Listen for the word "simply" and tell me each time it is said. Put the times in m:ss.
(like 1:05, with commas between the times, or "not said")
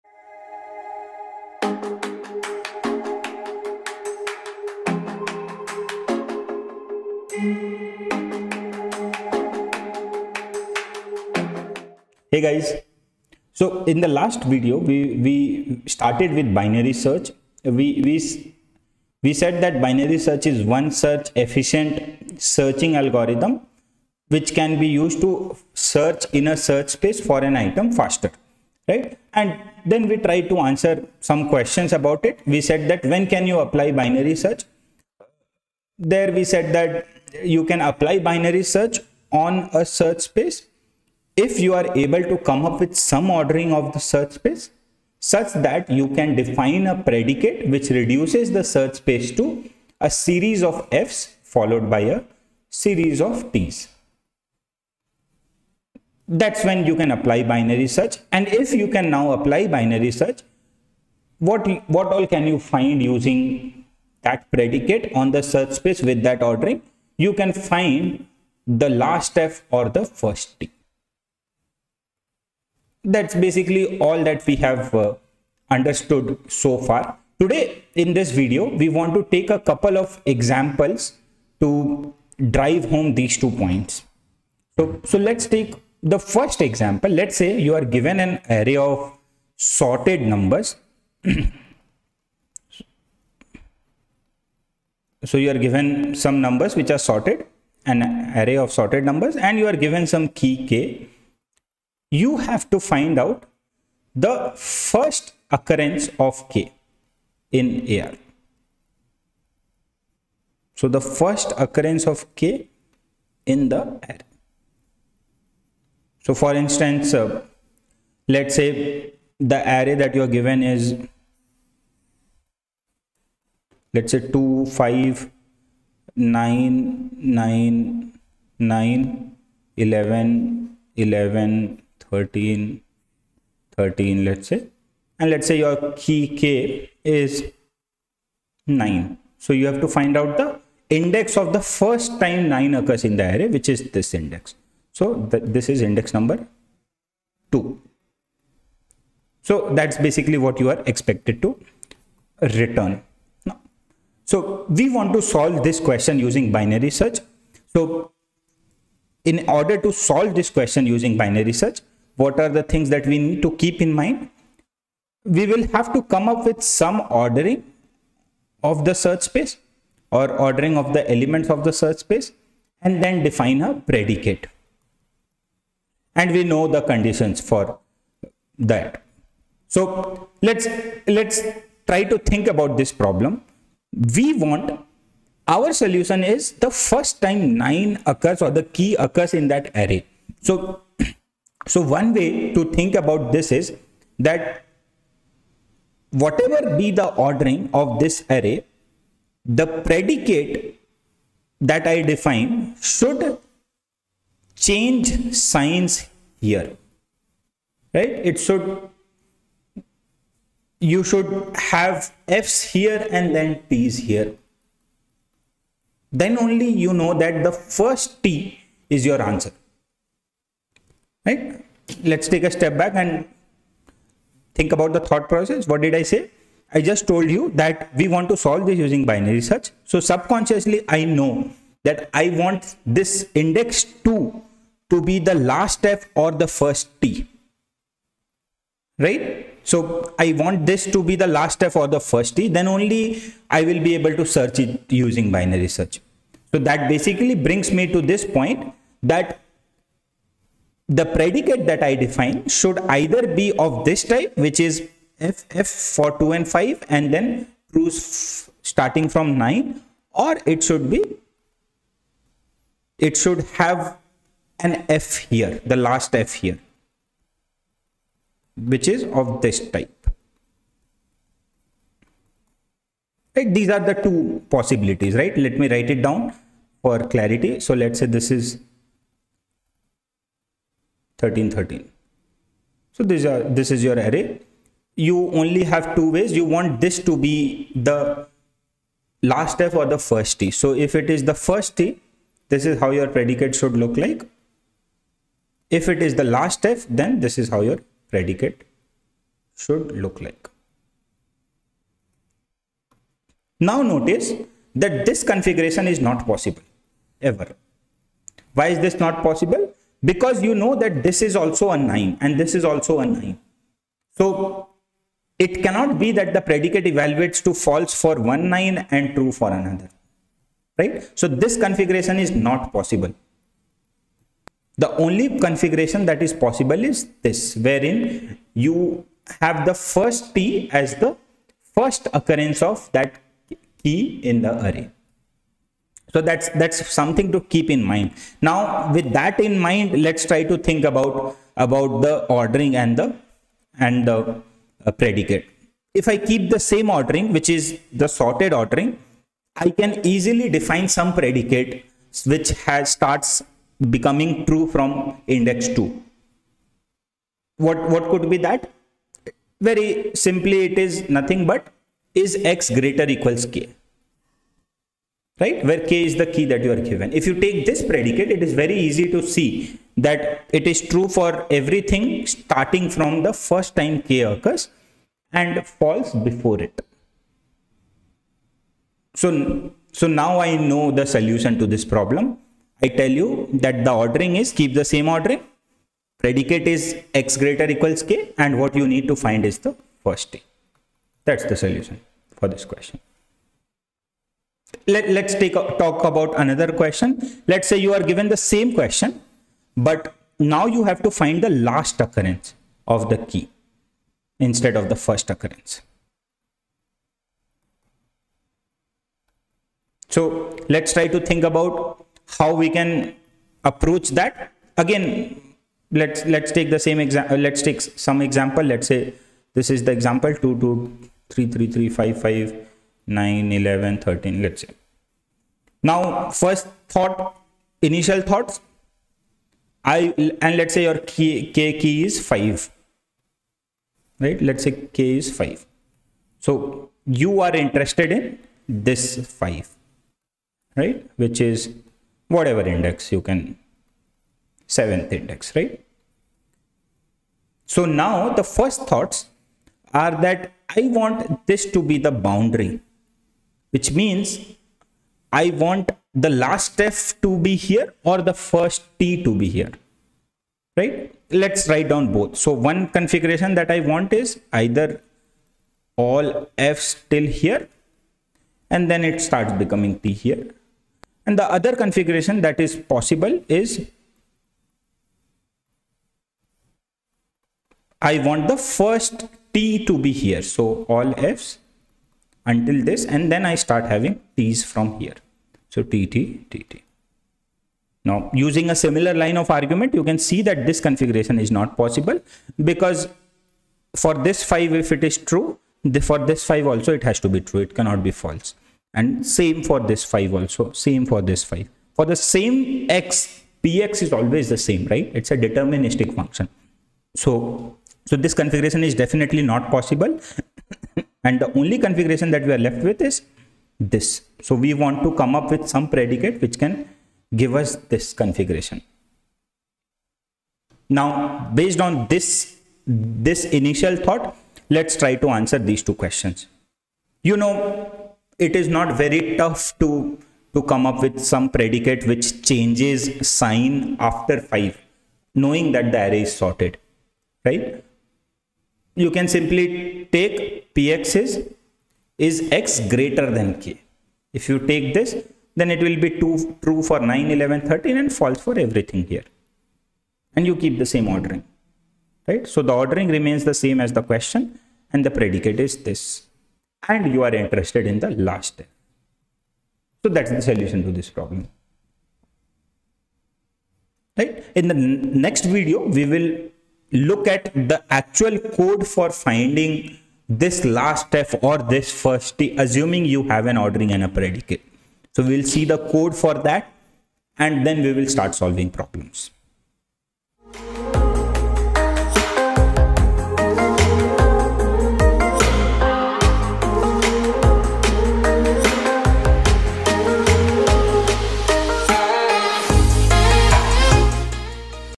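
6:00, 8:59.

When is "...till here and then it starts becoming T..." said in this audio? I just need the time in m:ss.
7:47.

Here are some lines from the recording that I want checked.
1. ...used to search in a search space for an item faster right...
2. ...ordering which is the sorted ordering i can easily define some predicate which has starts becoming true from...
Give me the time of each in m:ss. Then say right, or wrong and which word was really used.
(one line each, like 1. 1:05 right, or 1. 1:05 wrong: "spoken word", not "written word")
1. 0:24 right
2. 5:46 right.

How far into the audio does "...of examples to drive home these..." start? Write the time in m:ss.
1:19.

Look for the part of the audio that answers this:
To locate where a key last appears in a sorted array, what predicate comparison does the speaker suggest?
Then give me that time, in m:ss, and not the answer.
9:02.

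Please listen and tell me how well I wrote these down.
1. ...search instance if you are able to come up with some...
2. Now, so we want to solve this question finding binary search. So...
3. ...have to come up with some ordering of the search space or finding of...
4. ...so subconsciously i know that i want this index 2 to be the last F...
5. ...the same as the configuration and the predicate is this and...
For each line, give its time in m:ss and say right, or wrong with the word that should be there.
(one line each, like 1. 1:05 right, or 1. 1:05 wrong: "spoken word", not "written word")
1. 0:39 wrong: "space", not "instance"
2. 2:33 wrong: "using", not "finding"
3. 2:45 wrong: "ordering", not "finding"
4. 3:49 right
5. 9:13 wrong: "question", not "configuration".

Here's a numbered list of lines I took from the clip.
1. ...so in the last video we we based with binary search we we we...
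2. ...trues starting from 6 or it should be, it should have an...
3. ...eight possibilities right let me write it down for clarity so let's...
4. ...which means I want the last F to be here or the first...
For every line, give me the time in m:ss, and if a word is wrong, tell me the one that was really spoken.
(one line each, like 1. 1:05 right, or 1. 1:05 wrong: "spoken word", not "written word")
1. 0:13 wrong: "started", not "based"
2. 4:17 wrong: "9", not "6"
3. 4:34 wrong: "two", not "eight"
4. 7:33 right.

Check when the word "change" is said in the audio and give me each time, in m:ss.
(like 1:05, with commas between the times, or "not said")
3:24, 8:52.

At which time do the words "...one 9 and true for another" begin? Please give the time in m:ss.
5:18.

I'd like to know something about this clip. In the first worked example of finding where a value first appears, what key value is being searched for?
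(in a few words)
9.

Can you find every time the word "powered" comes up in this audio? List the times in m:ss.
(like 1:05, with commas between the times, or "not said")
not said.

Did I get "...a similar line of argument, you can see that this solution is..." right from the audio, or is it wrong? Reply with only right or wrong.
wrong.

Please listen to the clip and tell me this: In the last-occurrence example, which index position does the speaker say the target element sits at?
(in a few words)
seventh.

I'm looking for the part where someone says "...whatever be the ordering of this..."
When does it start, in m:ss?
3:16.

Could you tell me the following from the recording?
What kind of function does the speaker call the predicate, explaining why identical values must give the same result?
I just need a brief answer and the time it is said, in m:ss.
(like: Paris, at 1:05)
deterministic, at 8:25.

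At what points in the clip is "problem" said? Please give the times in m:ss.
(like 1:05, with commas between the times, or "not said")
3:02, 6:21, 9:21, 9:38.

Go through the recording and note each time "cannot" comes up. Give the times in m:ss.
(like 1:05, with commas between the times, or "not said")
5:15, 8:17.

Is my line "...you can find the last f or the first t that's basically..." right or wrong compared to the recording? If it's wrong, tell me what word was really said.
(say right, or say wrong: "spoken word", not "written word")
right.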